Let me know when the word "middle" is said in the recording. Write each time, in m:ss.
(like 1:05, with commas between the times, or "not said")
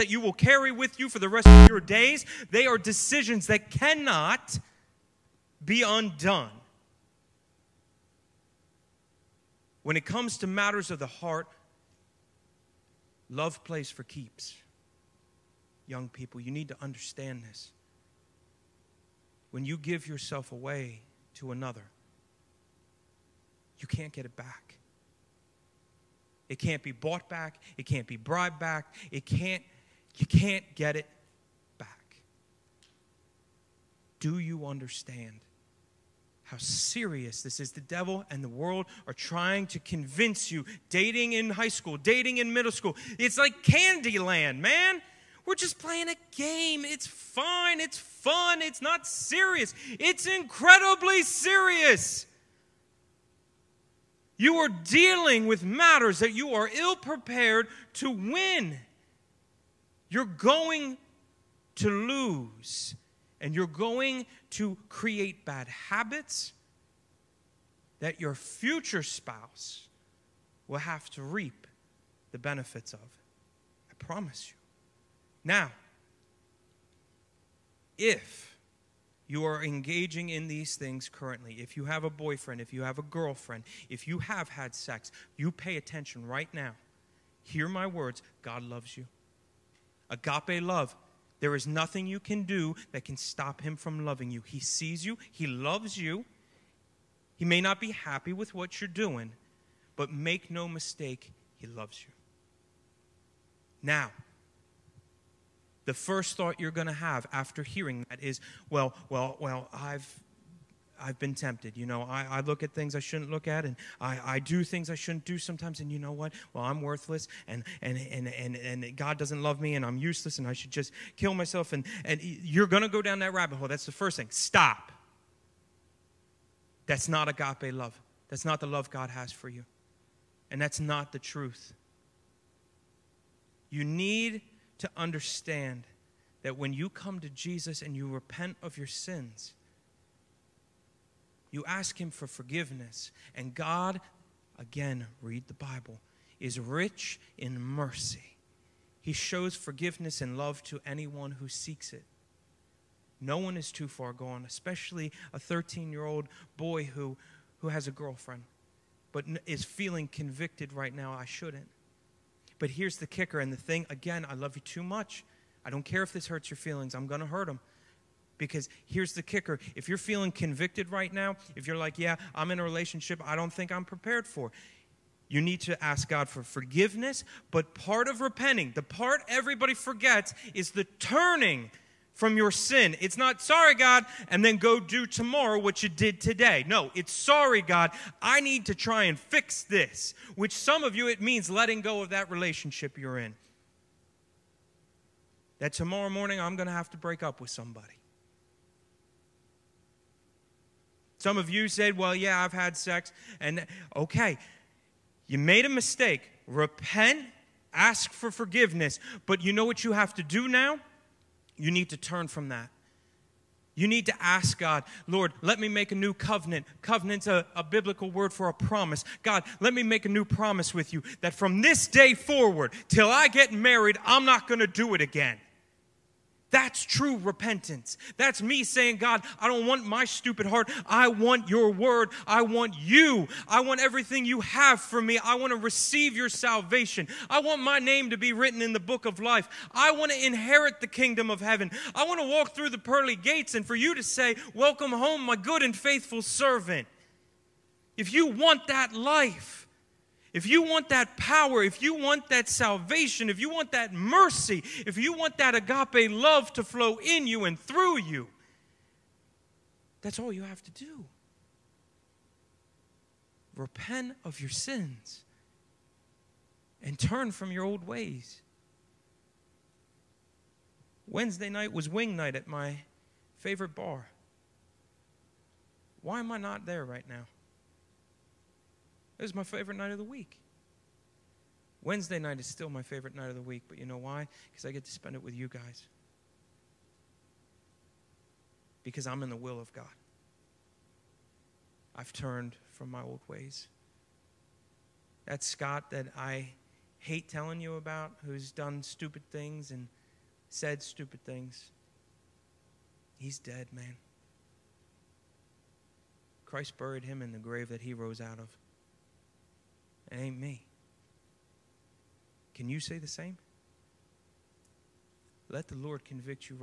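0:42.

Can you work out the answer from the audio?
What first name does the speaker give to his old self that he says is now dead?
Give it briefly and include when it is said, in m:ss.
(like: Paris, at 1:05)
Scott, at 4:55.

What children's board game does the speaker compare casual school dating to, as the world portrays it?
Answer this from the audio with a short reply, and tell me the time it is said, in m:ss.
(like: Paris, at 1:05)
Candyland, at 0:43.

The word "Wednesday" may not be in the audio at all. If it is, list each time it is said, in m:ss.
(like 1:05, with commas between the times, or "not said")
4:31, 4:41.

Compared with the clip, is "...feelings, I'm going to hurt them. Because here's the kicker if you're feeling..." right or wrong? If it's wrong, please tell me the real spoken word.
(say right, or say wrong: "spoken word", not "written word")
right.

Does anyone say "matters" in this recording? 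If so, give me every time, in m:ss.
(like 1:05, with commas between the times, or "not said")
0:10, 0:55.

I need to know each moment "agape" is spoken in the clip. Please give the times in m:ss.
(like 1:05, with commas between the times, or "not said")
1:30, 2:07, 4:15.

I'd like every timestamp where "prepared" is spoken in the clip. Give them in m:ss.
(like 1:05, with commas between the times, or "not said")
0:56, 2:53.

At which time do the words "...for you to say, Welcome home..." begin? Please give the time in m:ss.
4:03.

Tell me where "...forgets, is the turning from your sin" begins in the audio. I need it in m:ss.
2:59.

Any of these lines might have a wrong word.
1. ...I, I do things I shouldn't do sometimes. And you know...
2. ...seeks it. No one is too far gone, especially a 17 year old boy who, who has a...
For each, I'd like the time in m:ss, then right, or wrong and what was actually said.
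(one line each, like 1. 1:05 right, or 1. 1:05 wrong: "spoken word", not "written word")
1. 1:53 right
2. 2:31 wrong: "13", not "17".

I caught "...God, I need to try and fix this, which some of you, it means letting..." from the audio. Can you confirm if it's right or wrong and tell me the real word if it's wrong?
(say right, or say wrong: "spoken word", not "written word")
right.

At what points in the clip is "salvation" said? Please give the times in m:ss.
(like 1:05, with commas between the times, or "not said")
3:56, 4:12.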